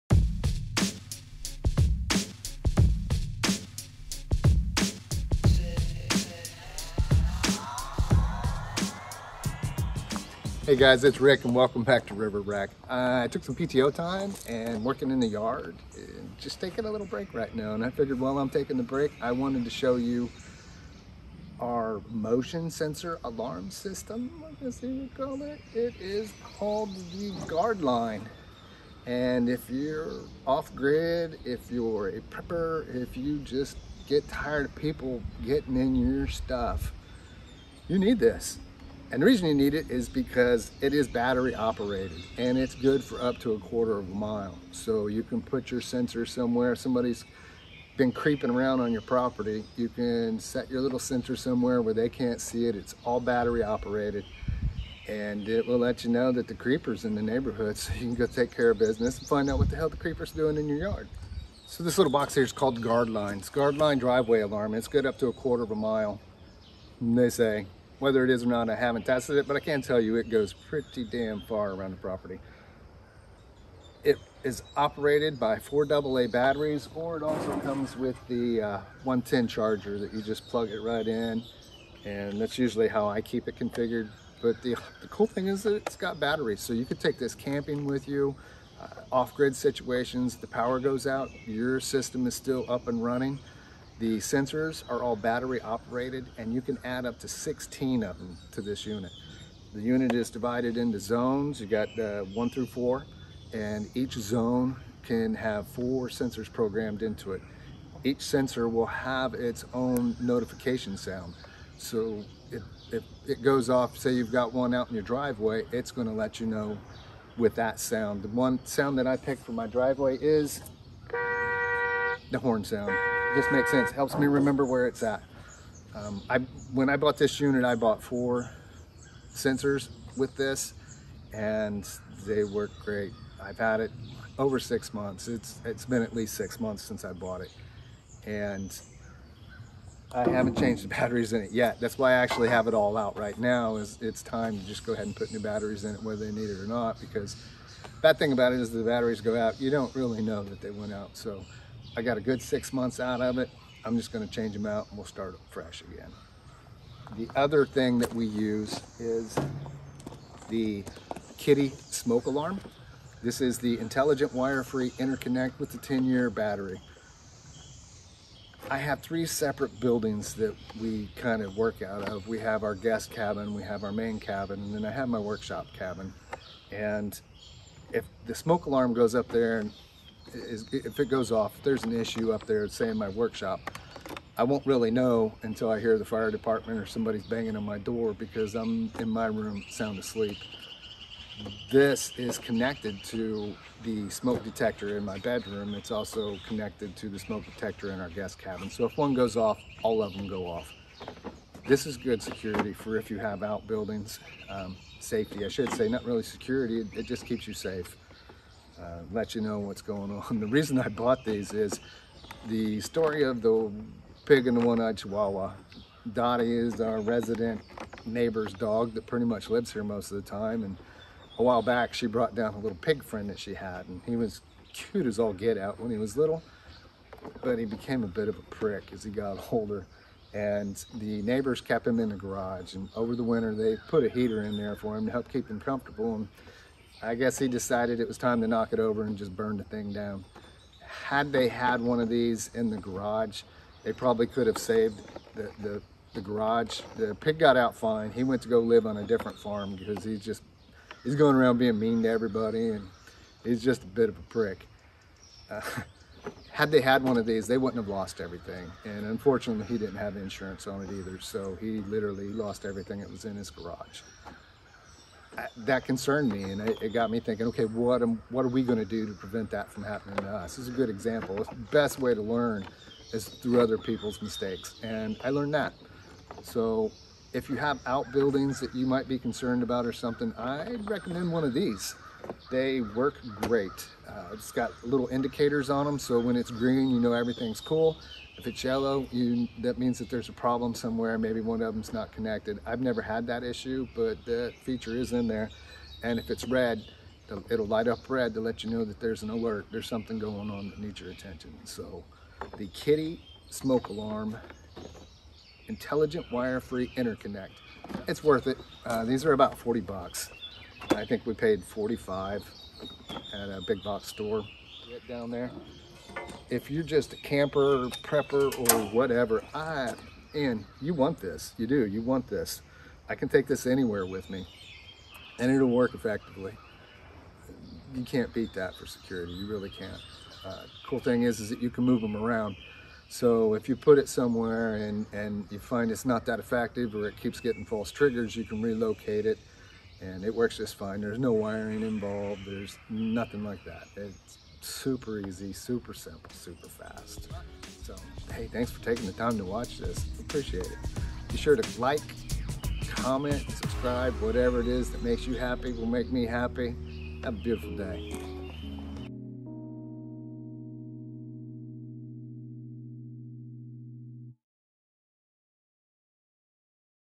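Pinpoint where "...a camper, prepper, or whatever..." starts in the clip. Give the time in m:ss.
5:17.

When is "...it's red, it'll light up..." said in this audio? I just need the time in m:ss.
4:56.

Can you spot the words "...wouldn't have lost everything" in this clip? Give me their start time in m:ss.
4:17.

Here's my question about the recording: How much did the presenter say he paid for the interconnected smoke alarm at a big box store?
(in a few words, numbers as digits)
$45.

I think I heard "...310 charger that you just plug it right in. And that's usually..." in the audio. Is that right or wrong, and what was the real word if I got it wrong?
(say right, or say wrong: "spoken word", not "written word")
wrong: "110", not "310".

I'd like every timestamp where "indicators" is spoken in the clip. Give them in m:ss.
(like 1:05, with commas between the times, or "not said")
4:45.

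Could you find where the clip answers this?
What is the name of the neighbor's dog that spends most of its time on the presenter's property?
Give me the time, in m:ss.
3:36.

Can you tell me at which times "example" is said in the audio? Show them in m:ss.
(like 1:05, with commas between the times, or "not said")
4:30.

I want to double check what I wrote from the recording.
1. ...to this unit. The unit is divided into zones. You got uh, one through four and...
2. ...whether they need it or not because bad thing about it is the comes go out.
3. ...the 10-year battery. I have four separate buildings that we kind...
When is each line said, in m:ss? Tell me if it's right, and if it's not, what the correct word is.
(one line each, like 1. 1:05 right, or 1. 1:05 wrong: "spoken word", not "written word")
1. 1:38 right
2. 2:26 wrong: "batteries", not "comes"
3. 2:45 wrong: "three", not "four".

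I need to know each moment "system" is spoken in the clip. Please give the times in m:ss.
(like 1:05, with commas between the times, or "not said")
0:23, 1:31.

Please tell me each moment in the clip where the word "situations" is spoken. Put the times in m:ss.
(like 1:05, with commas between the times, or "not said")
1:29.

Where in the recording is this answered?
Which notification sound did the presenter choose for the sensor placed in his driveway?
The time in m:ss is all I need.
2:02.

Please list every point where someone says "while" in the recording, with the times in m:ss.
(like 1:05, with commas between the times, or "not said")
0:18, 3:41.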